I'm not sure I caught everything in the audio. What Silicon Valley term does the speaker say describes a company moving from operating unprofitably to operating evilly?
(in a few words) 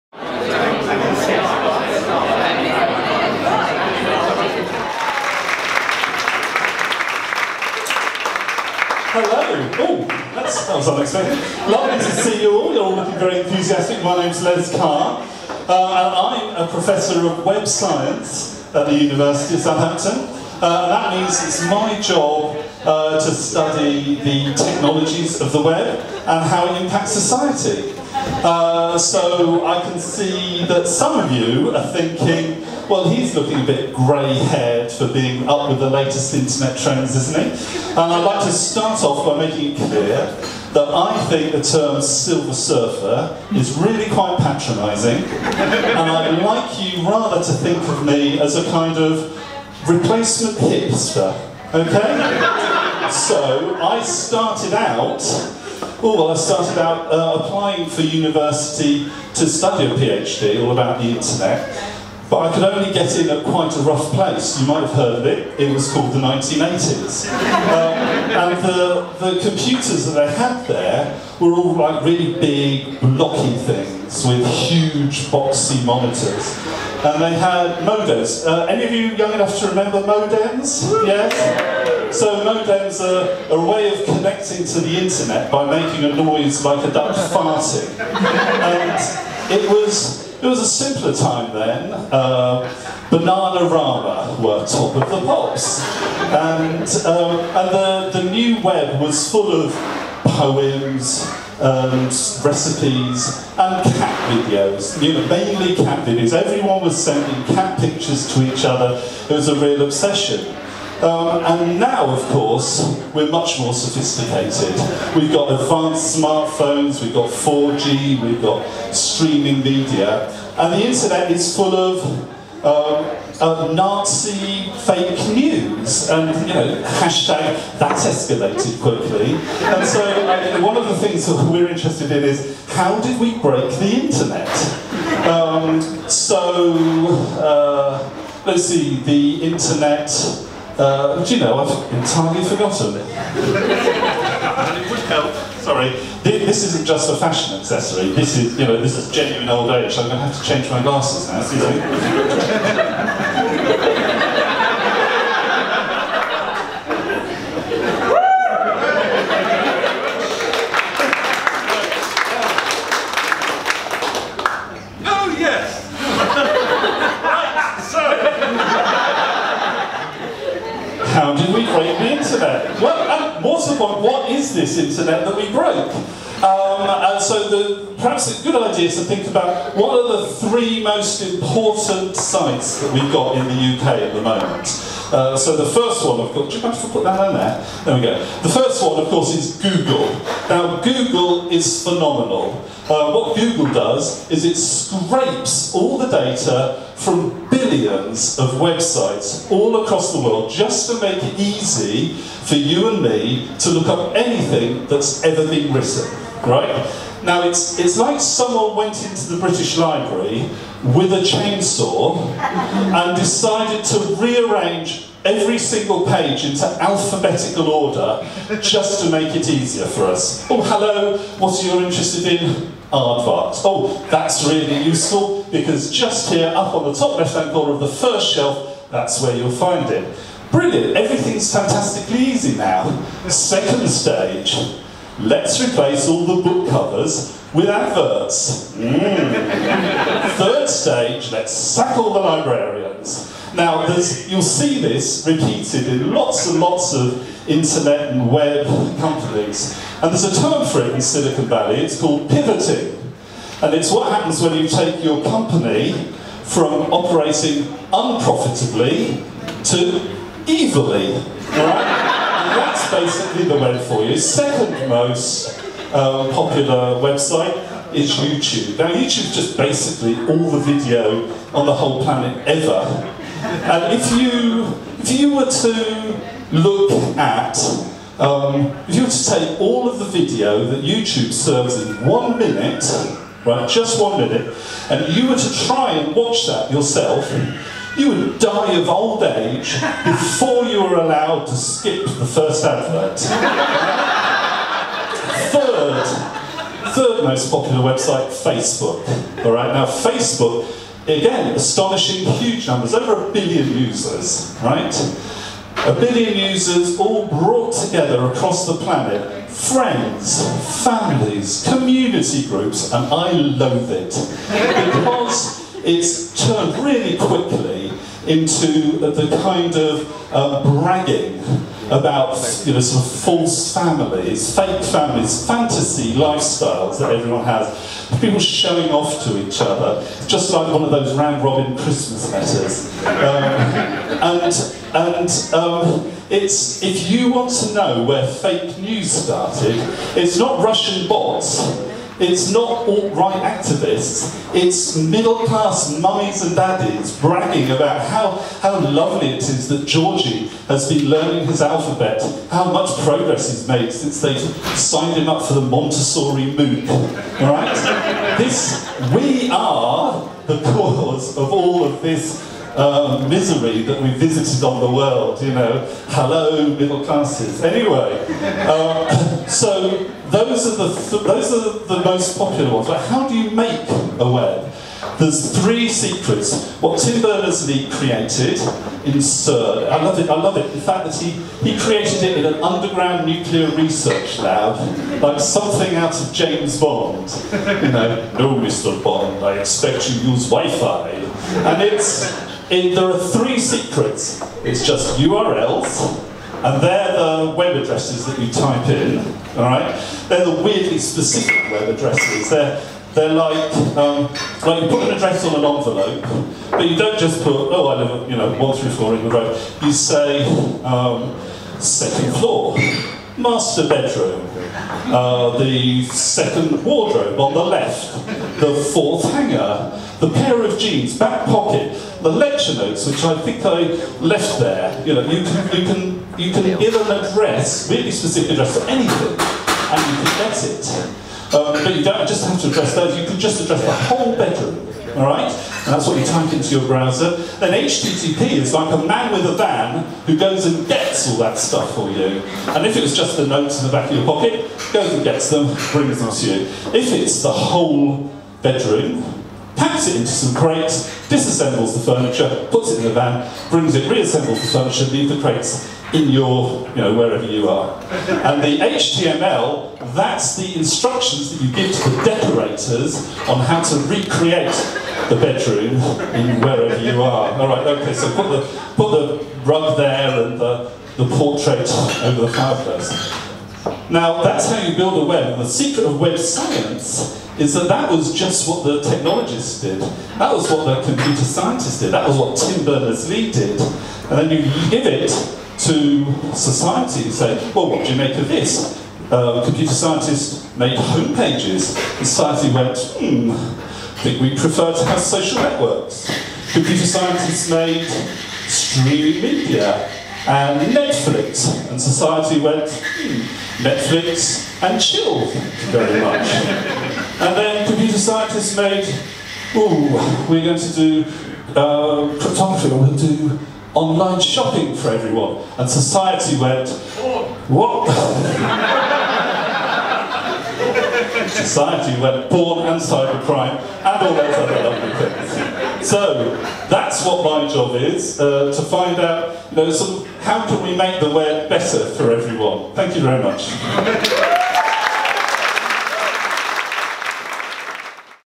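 Pivoting.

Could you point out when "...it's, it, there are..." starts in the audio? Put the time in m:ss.
6:31.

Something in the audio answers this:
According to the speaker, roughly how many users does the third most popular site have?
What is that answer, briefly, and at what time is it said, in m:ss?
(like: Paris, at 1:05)
Over a billion, at 5:02.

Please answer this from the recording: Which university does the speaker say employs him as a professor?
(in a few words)
University of Southampton.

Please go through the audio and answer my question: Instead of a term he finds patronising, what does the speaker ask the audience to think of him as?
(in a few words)
Replacement hipster.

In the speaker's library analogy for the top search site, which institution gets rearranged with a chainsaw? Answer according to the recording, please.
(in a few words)
British Library.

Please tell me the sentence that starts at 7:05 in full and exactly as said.
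You know, you can, you can, you can give an address, really specific address for anything, and you can get it.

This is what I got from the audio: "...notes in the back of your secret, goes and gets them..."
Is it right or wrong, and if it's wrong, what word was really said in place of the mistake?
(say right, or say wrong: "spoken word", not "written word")
wrong: "pocket", not "secret".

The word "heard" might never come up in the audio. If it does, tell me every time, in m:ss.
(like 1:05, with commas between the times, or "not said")
1:04.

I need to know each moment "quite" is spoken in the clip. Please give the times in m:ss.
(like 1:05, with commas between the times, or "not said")
0:44, 1:03.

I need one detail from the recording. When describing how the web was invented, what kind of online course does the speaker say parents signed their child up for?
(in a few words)
Montessori MOOC.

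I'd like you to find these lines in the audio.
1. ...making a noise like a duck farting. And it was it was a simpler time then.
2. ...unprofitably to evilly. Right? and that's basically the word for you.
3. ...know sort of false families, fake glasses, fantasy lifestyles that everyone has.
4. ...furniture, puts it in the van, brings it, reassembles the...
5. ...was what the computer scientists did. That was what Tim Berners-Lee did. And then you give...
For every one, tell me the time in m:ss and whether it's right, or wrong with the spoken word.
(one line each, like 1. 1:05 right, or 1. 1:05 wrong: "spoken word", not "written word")
1. 1:25 right
2. 4:17 right
3. 5:22 wrong: "families", not "glasses"
4. 7:32 right
5. 8:00 right.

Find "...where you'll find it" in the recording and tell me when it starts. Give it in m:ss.
3:49.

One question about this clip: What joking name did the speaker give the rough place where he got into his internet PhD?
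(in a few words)
The 1980s.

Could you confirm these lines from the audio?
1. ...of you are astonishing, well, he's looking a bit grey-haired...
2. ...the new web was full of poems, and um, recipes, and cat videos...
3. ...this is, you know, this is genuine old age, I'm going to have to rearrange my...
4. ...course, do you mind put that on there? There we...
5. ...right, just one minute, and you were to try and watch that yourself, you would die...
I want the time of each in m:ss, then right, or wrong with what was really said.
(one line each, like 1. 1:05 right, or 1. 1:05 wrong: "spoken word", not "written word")
1. 0:31 wrong: "thinking", not "astonishing"
2. 1:38 right
3. 2:28 wrong: "change", not "rearrange"
4. 3:06 right
5. 4:43 right.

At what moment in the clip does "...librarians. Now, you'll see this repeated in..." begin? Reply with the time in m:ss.
4:02.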